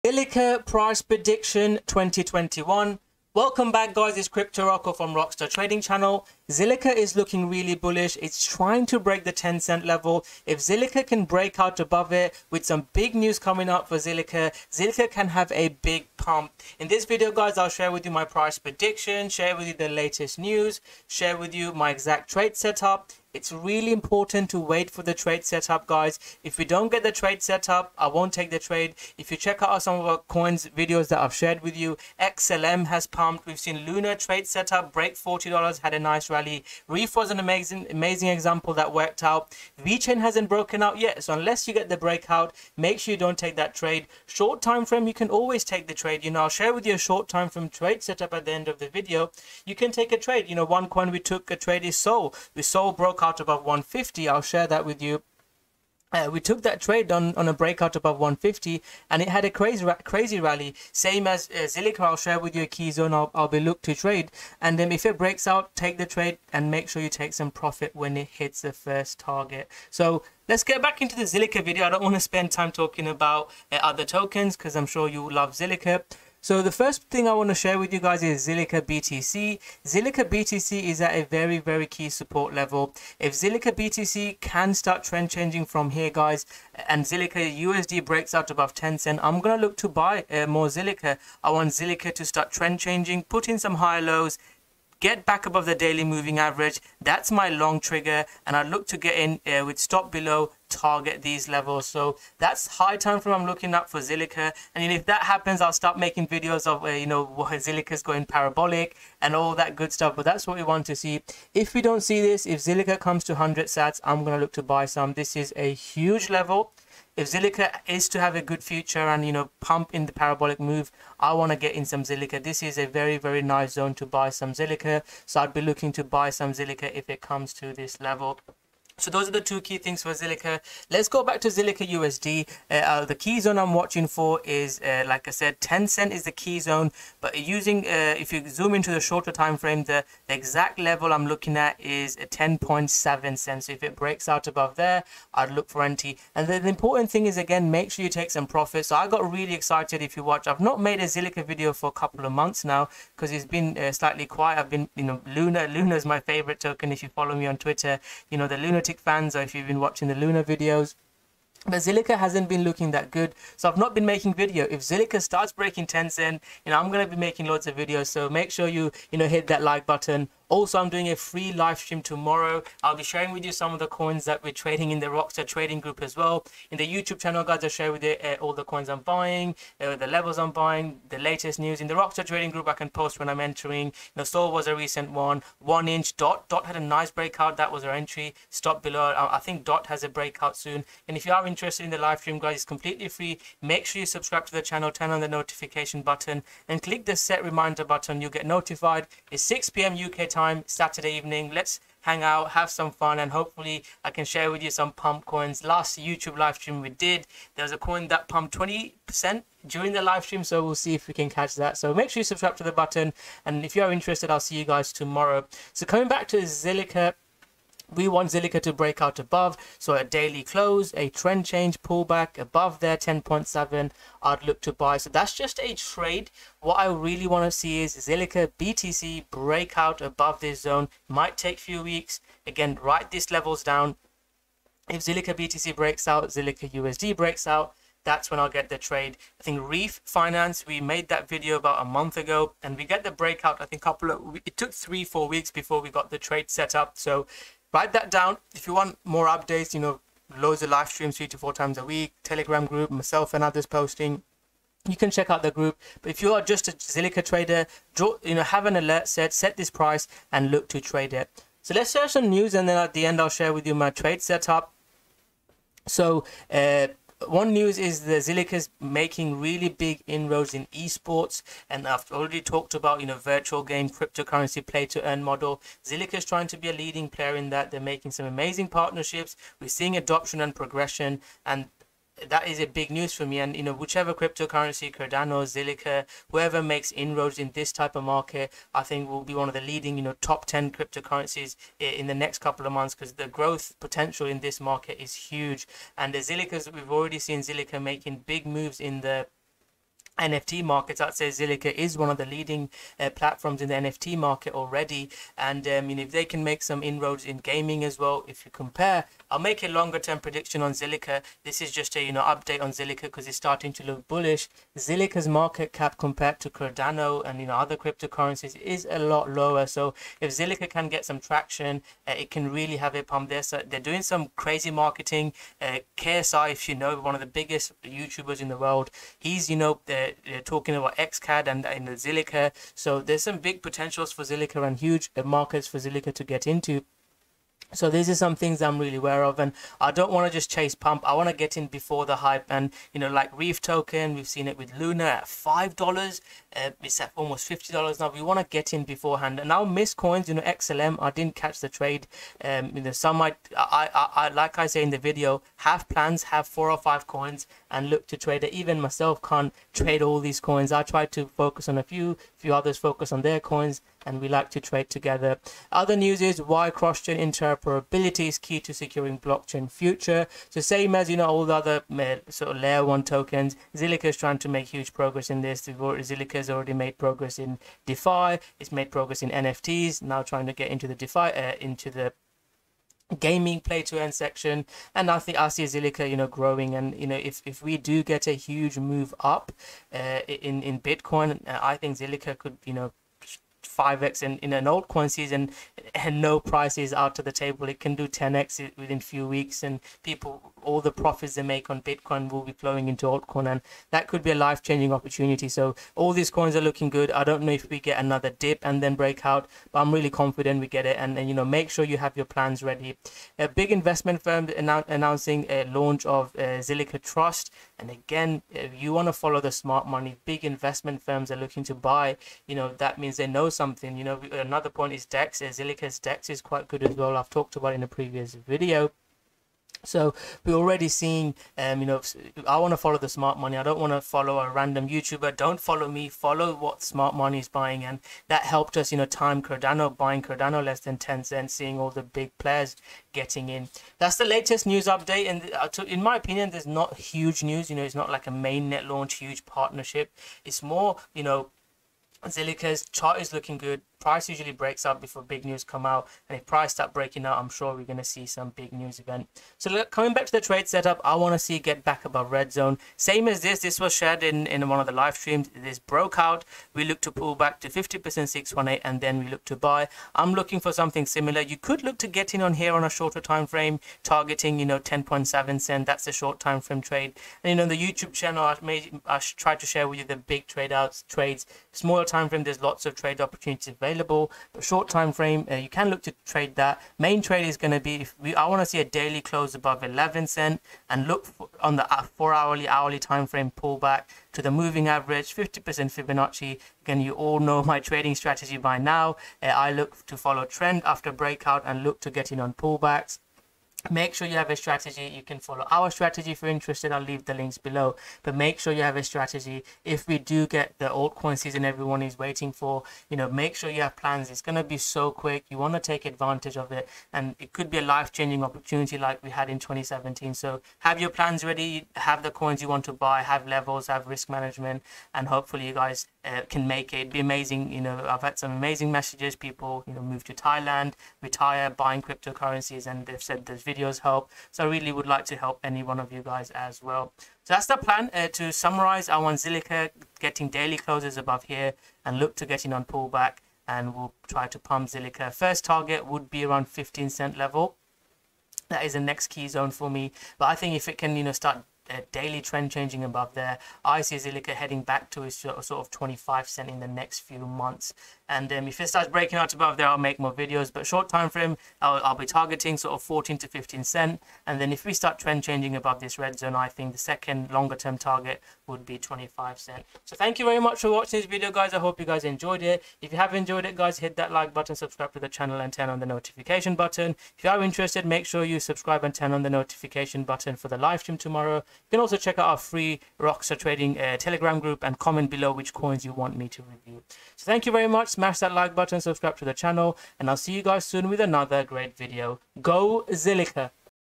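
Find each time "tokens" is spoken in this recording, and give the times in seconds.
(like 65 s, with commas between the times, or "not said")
74 s, 156 s, 343 s, 373 s.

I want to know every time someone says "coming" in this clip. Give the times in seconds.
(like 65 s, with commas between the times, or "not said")
13 s, 215 s, 459 s.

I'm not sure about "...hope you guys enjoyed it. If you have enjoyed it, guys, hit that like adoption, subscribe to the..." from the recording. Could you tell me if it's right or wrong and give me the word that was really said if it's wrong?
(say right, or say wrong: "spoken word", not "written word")
wrong: "button", not "adoption".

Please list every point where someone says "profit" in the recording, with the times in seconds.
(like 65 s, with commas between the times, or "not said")
67 s, 148 s, 400 s.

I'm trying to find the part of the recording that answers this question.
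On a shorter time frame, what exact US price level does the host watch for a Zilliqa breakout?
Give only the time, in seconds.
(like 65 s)
142 s.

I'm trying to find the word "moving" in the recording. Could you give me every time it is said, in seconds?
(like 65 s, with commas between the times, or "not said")
96 s, 494 s.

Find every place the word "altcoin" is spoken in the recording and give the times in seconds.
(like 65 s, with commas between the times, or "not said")
394 s, 403 s, 510 s.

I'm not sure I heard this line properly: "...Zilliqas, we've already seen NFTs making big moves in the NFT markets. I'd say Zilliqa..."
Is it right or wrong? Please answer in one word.
wrong.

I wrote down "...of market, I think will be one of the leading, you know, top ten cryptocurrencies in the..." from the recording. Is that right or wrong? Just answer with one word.
right.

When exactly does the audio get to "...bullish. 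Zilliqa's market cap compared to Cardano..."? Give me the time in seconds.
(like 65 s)
314 s.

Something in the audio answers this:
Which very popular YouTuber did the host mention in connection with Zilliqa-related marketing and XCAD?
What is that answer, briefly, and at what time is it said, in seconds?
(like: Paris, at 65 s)
KSI, at 325 s.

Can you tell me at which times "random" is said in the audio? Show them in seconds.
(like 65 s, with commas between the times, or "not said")
434 s.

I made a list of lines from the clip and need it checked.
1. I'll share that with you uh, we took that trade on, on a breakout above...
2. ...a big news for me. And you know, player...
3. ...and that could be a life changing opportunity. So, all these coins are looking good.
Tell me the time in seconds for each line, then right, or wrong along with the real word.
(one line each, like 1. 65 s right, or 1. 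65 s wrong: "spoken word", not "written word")
1. 54 s right
2. 282 s wrong: "whichever", not "player"
3. 403 s right.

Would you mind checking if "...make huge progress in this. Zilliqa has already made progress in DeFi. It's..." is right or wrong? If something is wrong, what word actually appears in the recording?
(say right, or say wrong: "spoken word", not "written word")
right.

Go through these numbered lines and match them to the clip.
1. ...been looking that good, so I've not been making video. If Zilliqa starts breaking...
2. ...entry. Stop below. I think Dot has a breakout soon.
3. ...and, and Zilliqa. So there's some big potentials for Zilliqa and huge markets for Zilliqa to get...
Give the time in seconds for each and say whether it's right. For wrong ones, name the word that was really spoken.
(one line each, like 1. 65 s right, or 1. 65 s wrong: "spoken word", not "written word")
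1. 162 s right
2. 187 s right
3. 331 s right.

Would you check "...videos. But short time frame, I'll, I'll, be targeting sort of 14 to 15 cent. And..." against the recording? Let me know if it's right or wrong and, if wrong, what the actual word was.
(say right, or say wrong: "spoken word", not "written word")
right.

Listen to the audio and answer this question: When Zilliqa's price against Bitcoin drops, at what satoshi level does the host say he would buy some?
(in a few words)
100 sats.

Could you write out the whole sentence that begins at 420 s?
Big investment firms are looking to buy, you know, that means they know something.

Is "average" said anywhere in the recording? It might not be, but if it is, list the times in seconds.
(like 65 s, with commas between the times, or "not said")
96 s, 494 s.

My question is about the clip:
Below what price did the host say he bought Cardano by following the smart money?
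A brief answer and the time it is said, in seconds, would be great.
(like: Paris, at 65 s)
10 cents, at 440 s.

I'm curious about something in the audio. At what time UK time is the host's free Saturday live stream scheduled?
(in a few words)
6 p.m.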